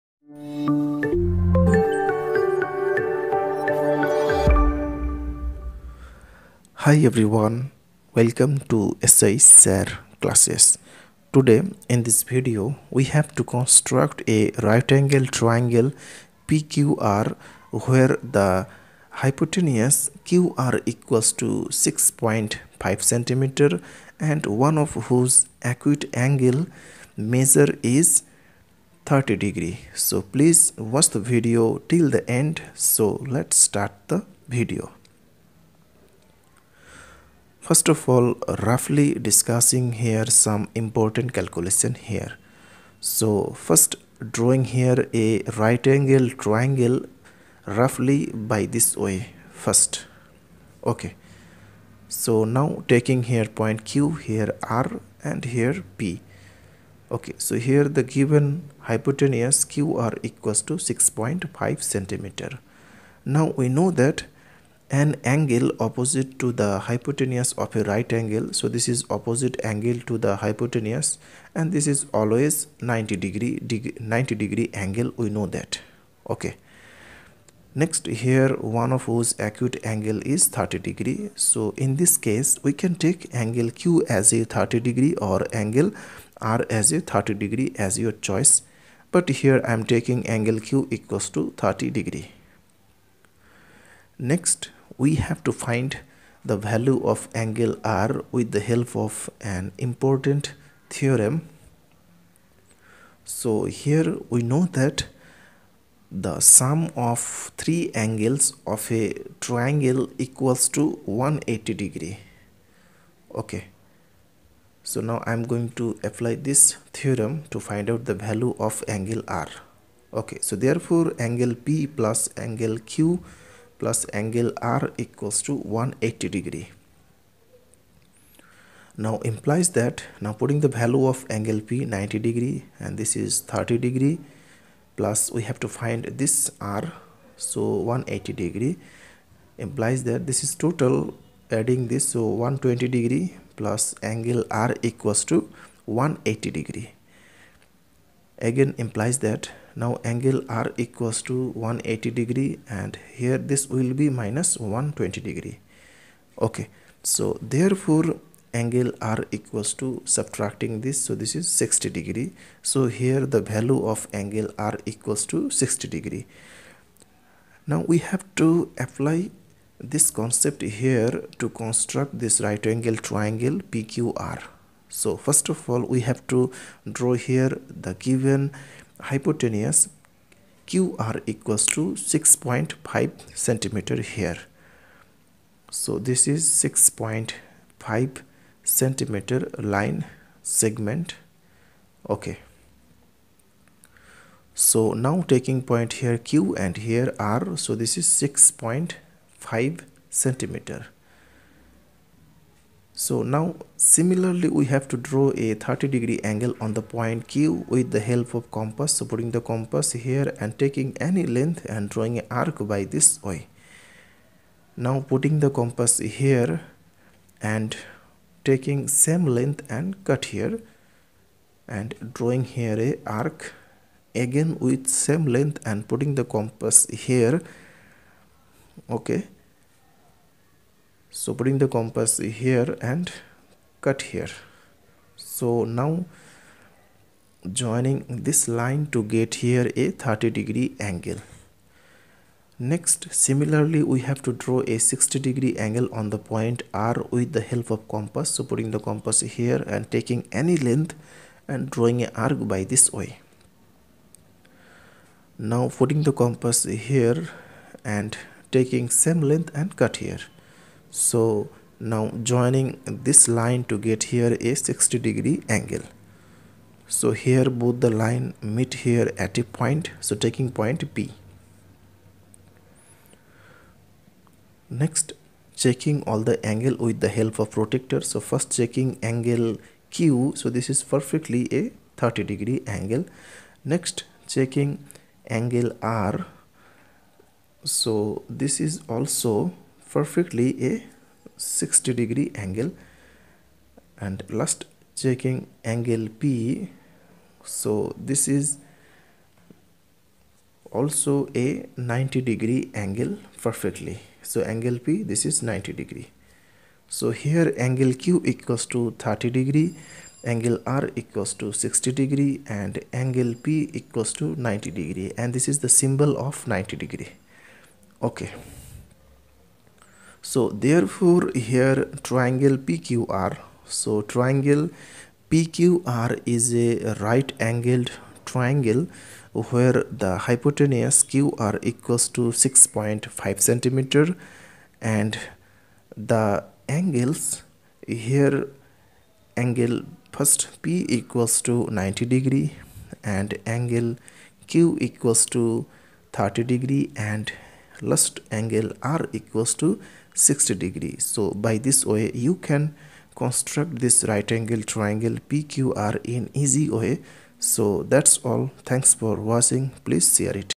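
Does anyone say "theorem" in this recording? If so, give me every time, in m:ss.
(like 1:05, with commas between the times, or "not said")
1:40, 1:56.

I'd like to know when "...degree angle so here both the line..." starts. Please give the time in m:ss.
4:24.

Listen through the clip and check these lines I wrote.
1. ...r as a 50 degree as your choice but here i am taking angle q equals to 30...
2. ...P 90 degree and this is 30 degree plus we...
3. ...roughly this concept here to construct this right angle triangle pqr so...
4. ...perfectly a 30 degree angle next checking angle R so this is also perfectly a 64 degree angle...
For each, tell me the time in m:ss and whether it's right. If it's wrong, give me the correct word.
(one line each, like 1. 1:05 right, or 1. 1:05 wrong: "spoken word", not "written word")
1. 1:26 wrong: "30", not "50"
2. 2:11 right
3. 2:48 wrong: "apply", not "roughly"
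4. 4:40 wrong: "60", not "64".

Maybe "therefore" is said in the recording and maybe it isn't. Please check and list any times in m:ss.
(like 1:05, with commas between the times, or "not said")
2:00, 2:37, 5:20.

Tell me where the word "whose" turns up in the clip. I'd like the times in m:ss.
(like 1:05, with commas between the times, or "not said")
0:25, 1:19.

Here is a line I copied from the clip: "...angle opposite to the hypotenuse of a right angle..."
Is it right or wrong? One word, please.
right.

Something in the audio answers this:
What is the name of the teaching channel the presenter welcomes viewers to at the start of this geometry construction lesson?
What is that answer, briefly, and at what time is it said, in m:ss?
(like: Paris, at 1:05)
SH SIR classes, at 0:09.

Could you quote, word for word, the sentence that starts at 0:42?
So first drawing here a right angle triangle roughly by this way first.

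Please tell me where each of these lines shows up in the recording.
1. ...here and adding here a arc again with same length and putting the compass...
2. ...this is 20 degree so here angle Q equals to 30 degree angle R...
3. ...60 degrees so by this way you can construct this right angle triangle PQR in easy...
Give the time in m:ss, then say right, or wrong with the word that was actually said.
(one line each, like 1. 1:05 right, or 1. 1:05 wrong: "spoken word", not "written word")
1. 3:40 wrong: "drawing", not "adding"
2. 5:05 wrong: "90", not "20"
3. 5:50 right.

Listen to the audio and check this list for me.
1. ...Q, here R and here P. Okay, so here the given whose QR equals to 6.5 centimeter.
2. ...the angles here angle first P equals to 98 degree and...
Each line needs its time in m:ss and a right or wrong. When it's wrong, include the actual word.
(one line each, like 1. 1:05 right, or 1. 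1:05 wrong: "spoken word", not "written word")
1. 0:53 wrong: "hypotenuse", not "whose"
2. 5:35 wrong: "90", not "98".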